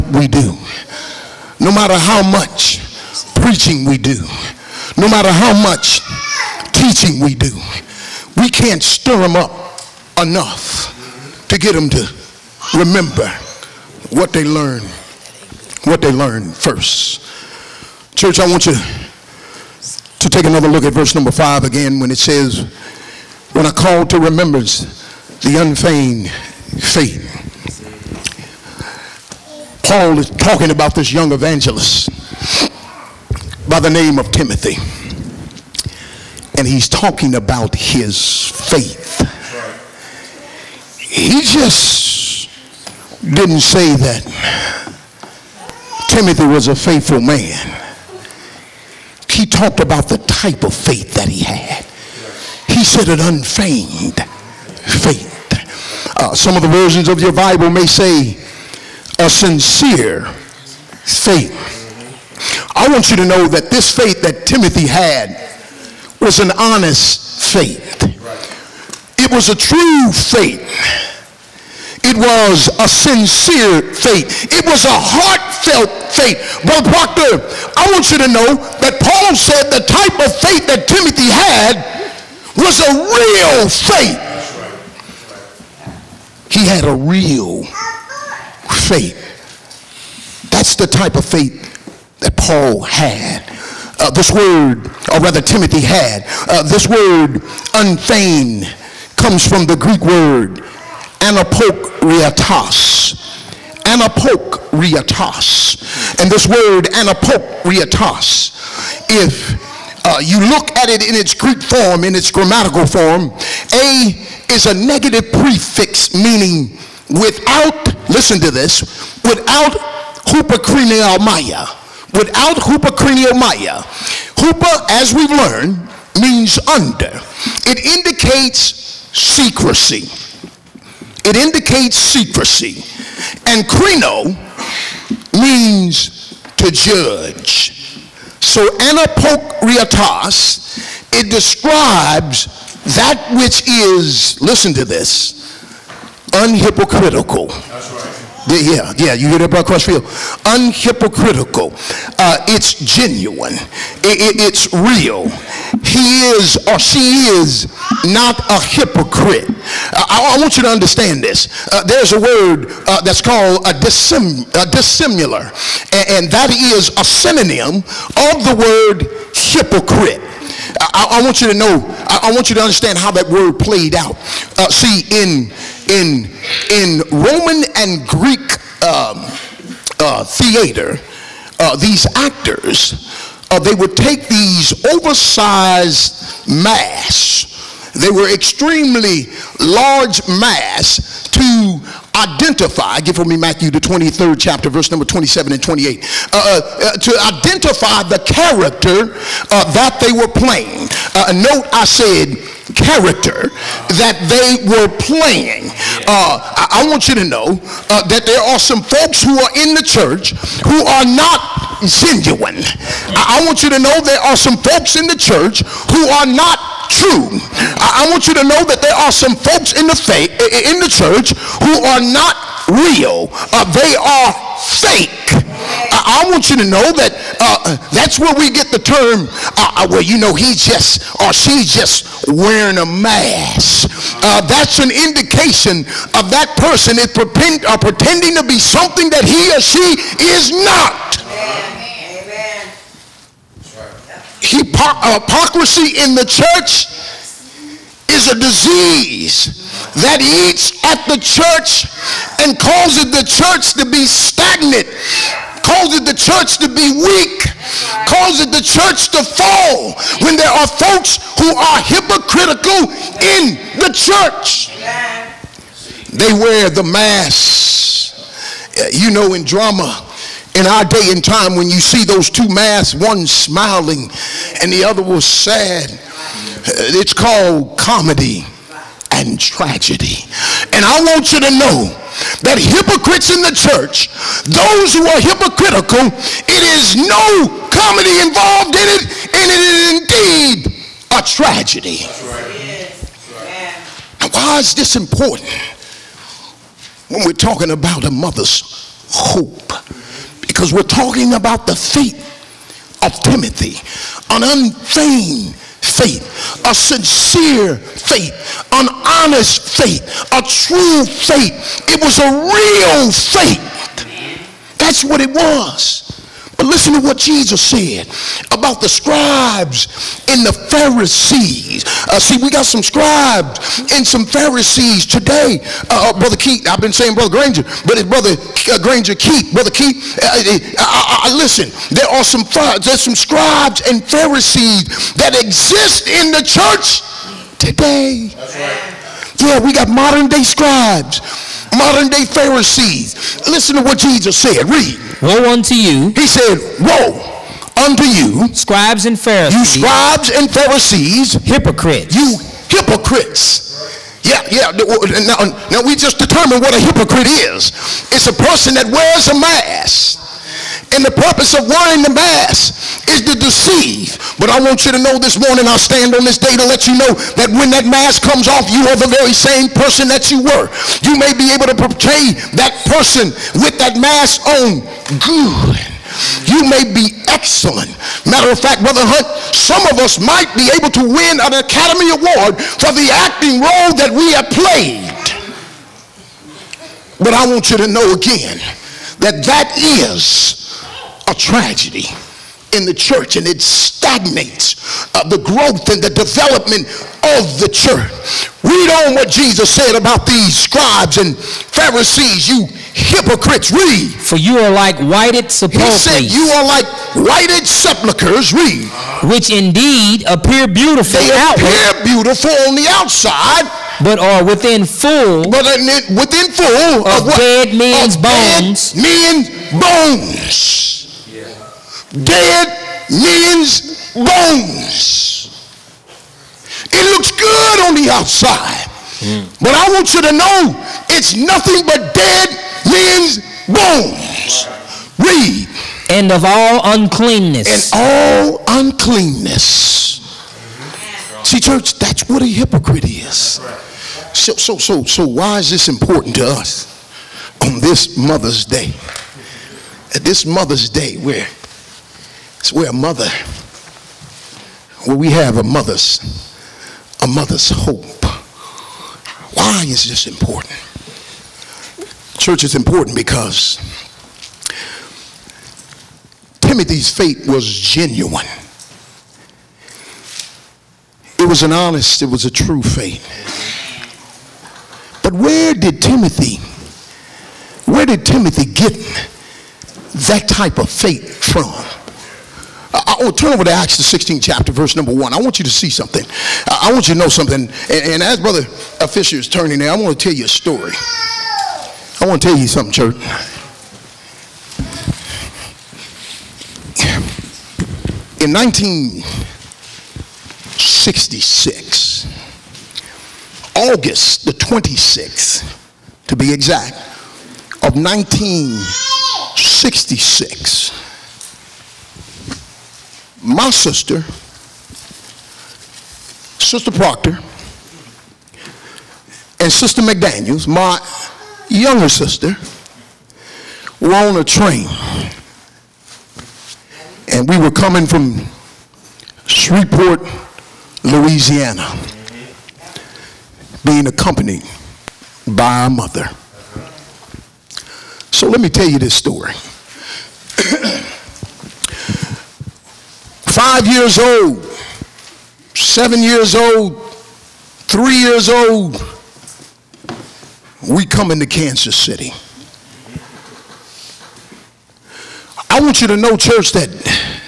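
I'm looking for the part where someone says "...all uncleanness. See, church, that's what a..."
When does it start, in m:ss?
7:18.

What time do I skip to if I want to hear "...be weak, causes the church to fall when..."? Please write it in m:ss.
4:16.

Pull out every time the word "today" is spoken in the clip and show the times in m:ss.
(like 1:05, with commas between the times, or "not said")
5:25, 5:37.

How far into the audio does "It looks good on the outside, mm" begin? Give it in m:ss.
7:06.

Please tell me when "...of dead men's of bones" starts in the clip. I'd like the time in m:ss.
6:57.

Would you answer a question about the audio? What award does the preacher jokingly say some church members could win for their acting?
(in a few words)
Academy Award.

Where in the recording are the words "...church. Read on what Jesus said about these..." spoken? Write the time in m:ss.
6:37.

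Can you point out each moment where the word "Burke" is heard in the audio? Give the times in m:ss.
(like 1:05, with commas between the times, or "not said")
not said.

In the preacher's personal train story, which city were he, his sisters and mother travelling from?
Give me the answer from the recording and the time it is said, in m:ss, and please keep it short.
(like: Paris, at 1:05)
Shreveport, Louisiana, at 8:49.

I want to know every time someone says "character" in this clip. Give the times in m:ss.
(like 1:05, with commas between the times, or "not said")
3:18, 3:22.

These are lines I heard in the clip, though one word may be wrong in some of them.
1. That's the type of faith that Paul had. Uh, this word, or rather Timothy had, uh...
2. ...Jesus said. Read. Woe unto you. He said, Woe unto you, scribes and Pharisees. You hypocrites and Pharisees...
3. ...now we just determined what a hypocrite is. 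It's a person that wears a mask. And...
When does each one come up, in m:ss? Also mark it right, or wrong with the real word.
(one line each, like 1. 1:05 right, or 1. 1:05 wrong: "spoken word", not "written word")
1. 1:30 right
2. 5:43 wrong: "scribes", not "hypocrites"
3. 5:55 right.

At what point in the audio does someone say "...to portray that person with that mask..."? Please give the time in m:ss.
6:11.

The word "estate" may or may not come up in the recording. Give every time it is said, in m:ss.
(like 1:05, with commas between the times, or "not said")
not said.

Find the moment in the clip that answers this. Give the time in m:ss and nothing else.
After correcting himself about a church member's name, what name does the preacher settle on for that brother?
5:28.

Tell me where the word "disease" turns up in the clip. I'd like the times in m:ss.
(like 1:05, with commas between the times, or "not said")
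4:08.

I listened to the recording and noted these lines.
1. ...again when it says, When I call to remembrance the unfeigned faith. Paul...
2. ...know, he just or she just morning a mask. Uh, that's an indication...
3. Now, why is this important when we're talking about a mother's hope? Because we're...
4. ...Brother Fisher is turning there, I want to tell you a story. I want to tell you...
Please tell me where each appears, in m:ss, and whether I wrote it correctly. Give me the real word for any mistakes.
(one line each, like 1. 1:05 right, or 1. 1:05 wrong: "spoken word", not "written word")
1. 0:21 right
2. 3:50 wrong: "wearing", not "morning"
3. 4:54 right
4. 8:08 right.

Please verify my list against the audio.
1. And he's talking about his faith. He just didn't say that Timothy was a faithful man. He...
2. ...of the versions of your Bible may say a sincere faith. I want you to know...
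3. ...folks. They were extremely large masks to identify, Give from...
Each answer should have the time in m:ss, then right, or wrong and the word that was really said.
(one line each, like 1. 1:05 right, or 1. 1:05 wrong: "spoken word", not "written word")
1. 0:36 right
2. 0:56 right
3. 3:06 wrong: "masks", not "folks".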